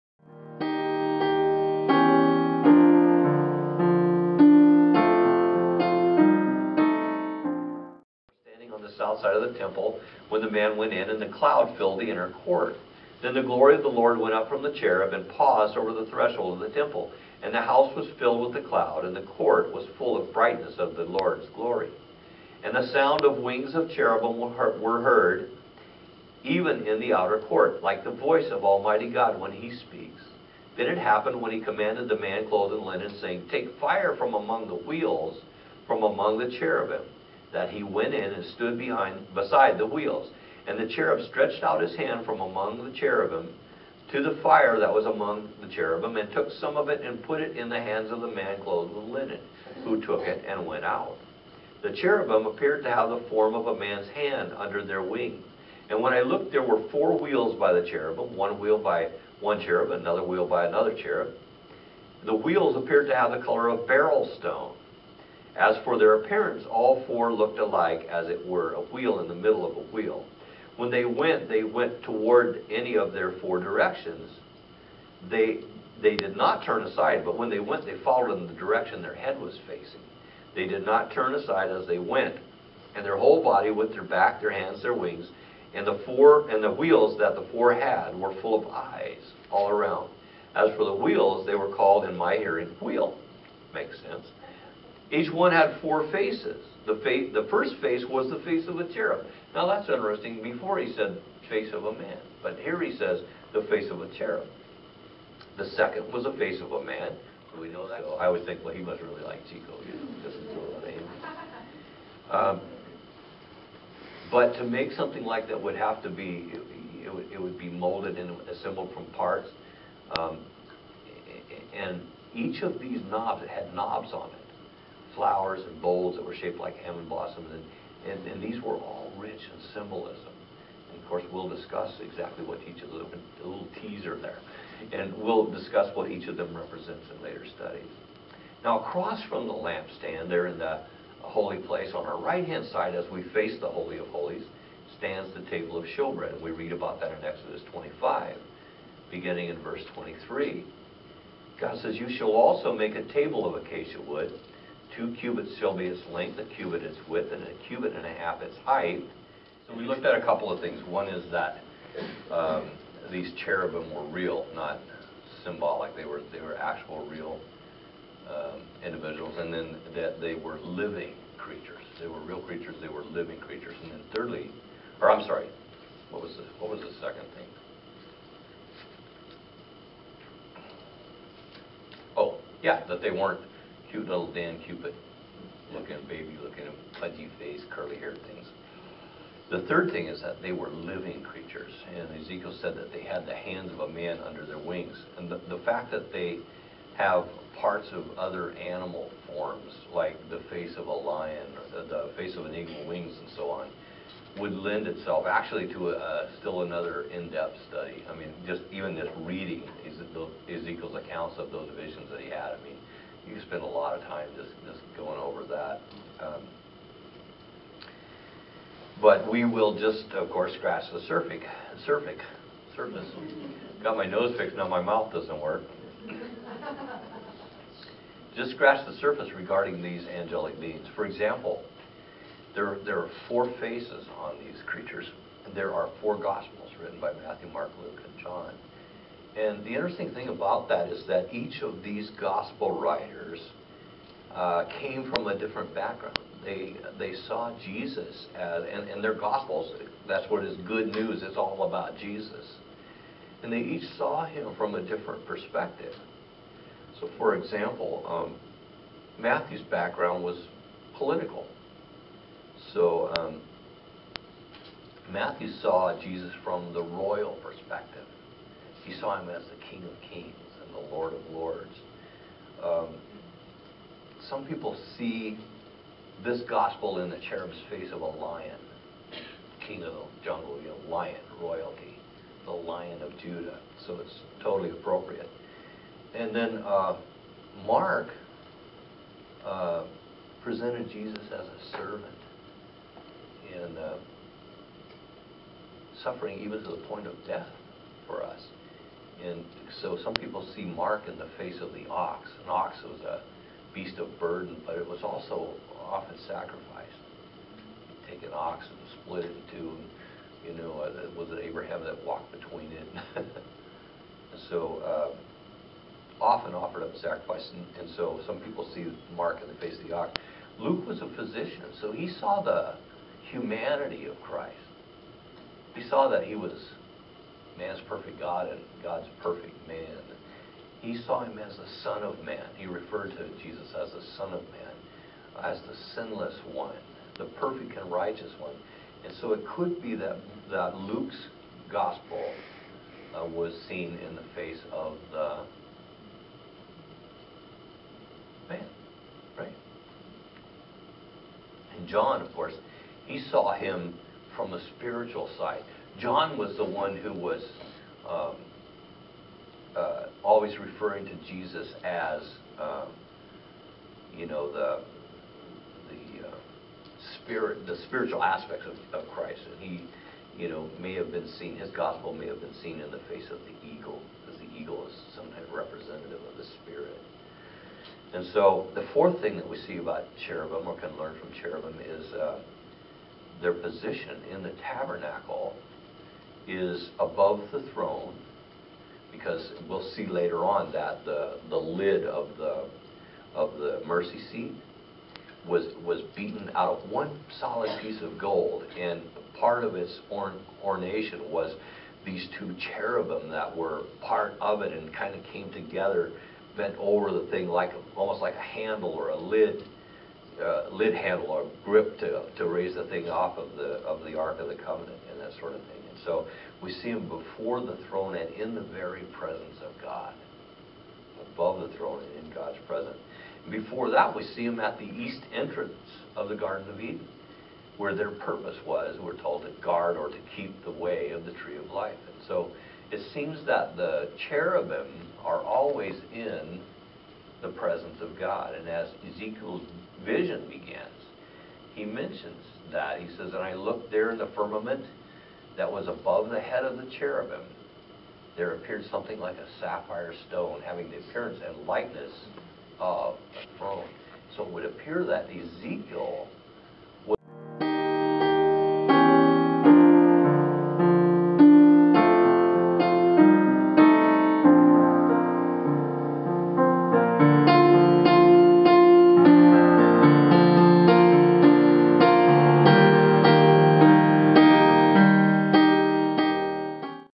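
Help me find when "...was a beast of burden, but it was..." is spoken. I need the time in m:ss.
5:02.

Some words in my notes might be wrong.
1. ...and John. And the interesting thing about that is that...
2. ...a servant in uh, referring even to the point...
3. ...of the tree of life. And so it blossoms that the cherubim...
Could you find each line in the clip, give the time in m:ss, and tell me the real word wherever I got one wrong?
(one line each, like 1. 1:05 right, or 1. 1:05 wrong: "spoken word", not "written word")
1. 3:58 right
2. 4:51 wrong: "suffering", not "referring"
3. 7:11 wrong: "seems", not "blossoms".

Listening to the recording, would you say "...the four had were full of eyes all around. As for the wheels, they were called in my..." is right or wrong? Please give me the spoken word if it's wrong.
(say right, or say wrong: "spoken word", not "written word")
right.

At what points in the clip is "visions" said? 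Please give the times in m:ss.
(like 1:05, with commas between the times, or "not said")
3:31, 7:20.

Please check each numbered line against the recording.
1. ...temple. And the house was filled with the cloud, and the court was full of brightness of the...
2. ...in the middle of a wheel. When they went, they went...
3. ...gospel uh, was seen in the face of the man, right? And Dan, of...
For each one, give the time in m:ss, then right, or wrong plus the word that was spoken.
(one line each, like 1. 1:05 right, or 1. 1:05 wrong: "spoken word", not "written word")
1. 0:16 right
2. 1:09 right
3. 5:41 wrong: "John", not "Dan".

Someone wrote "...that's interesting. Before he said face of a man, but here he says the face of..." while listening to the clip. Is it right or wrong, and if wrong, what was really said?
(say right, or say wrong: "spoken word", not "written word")
right.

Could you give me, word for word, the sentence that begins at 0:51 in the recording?
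The cherubim appeared to have the form of a man's hand under their wing.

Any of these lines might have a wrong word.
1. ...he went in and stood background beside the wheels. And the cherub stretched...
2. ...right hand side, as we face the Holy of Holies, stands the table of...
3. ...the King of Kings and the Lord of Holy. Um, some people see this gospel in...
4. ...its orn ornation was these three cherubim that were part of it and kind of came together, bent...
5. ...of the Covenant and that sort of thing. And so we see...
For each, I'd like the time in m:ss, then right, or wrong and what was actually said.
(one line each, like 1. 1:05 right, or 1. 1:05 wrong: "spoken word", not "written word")
1. 0:37 wrong: "behind", not "background"
2. 2:22 right
3. 4:29 wrong: "Lords", not "Holy"
4. 6:39 wrong: "two", not "three"
5. 6:54 right.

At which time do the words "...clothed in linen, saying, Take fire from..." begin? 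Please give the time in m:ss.
0:32.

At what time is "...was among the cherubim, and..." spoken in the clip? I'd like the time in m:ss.
0:44.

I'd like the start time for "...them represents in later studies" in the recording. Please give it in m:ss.
2:16.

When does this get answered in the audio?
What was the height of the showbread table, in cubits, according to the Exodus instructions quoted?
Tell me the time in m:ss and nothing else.
2:37.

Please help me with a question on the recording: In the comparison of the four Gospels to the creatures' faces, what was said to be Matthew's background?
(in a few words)
political.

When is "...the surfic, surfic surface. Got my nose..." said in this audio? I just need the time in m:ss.
3:40.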